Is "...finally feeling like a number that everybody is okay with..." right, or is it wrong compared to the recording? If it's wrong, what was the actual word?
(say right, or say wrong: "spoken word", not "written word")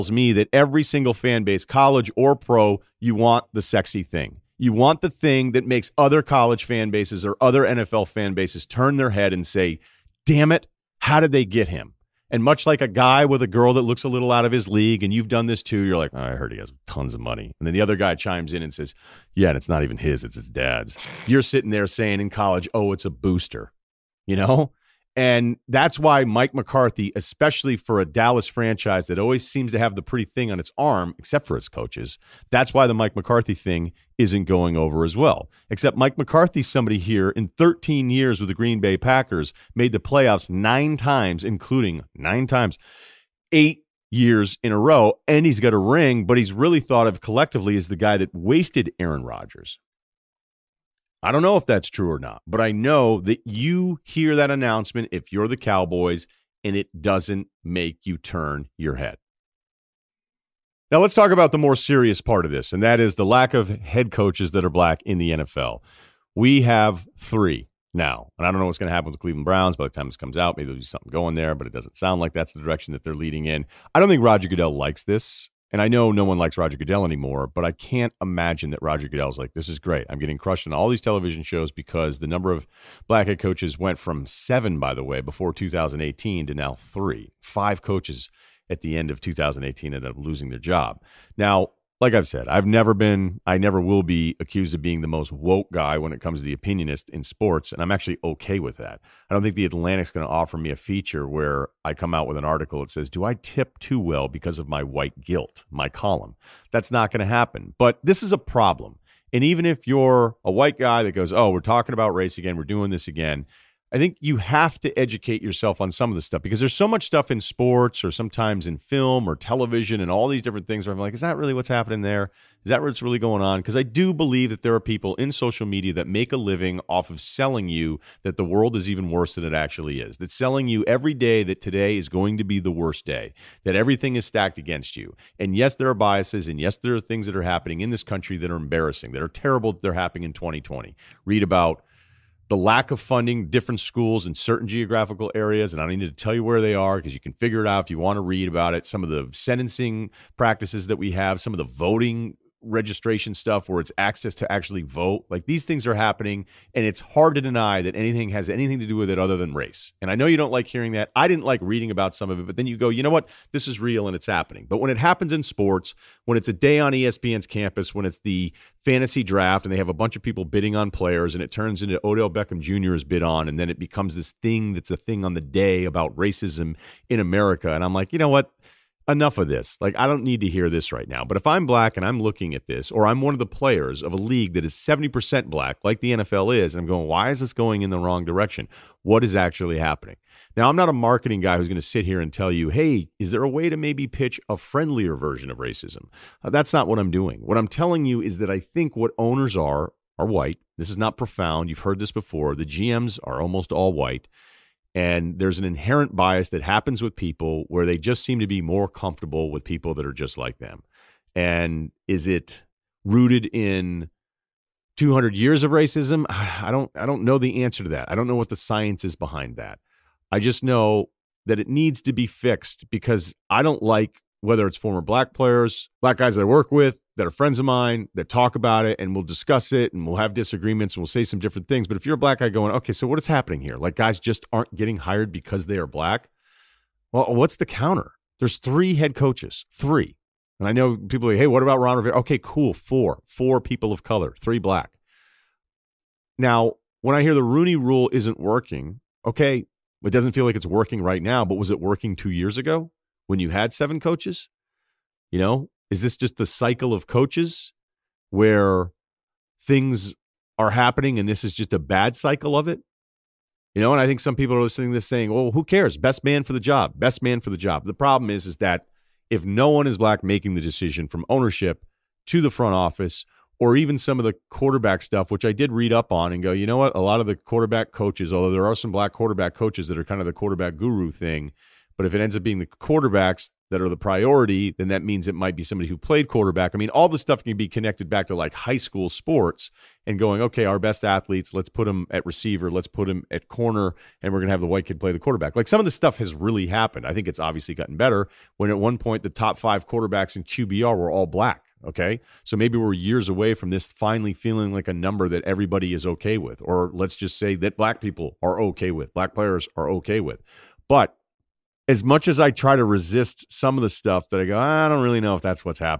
right.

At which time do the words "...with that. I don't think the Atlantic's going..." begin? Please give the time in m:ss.
1:38.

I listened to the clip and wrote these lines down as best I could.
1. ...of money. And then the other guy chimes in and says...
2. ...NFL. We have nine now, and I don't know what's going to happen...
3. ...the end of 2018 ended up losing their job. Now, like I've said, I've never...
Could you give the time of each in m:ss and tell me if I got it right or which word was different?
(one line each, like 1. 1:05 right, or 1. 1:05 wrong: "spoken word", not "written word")
1. 0:17 right
2. 1:05 wrong: "three", not "nine"
3. 1:28 right.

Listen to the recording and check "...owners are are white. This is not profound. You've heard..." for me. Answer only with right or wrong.
right.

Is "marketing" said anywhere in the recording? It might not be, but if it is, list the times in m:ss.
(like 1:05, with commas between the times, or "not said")
3:10.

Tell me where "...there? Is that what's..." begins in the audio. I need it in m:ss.
2:02.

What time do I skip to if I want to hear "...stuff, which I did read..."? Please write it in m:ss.
4:35.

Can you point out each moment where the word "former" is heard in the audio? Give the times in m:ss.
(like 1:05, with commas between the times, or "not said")
3:44.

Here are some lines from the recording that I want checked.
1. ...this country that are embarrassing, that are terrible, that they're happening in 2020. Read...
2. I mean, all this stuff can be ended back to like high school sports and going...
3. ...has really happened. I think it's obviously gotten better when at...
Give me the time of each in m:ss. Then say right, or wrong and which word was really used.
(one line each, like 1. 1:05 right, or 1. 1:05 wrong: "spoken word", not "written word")
1. 2:17 right
2. 4:46 wrong: "connected", not "ended"
3. 4:56 right.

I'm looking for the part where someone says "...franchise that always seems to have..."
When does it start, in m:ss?
0:28.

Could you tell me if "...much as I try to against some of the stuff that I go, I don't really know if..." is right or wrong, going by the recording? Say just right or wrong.
wrong.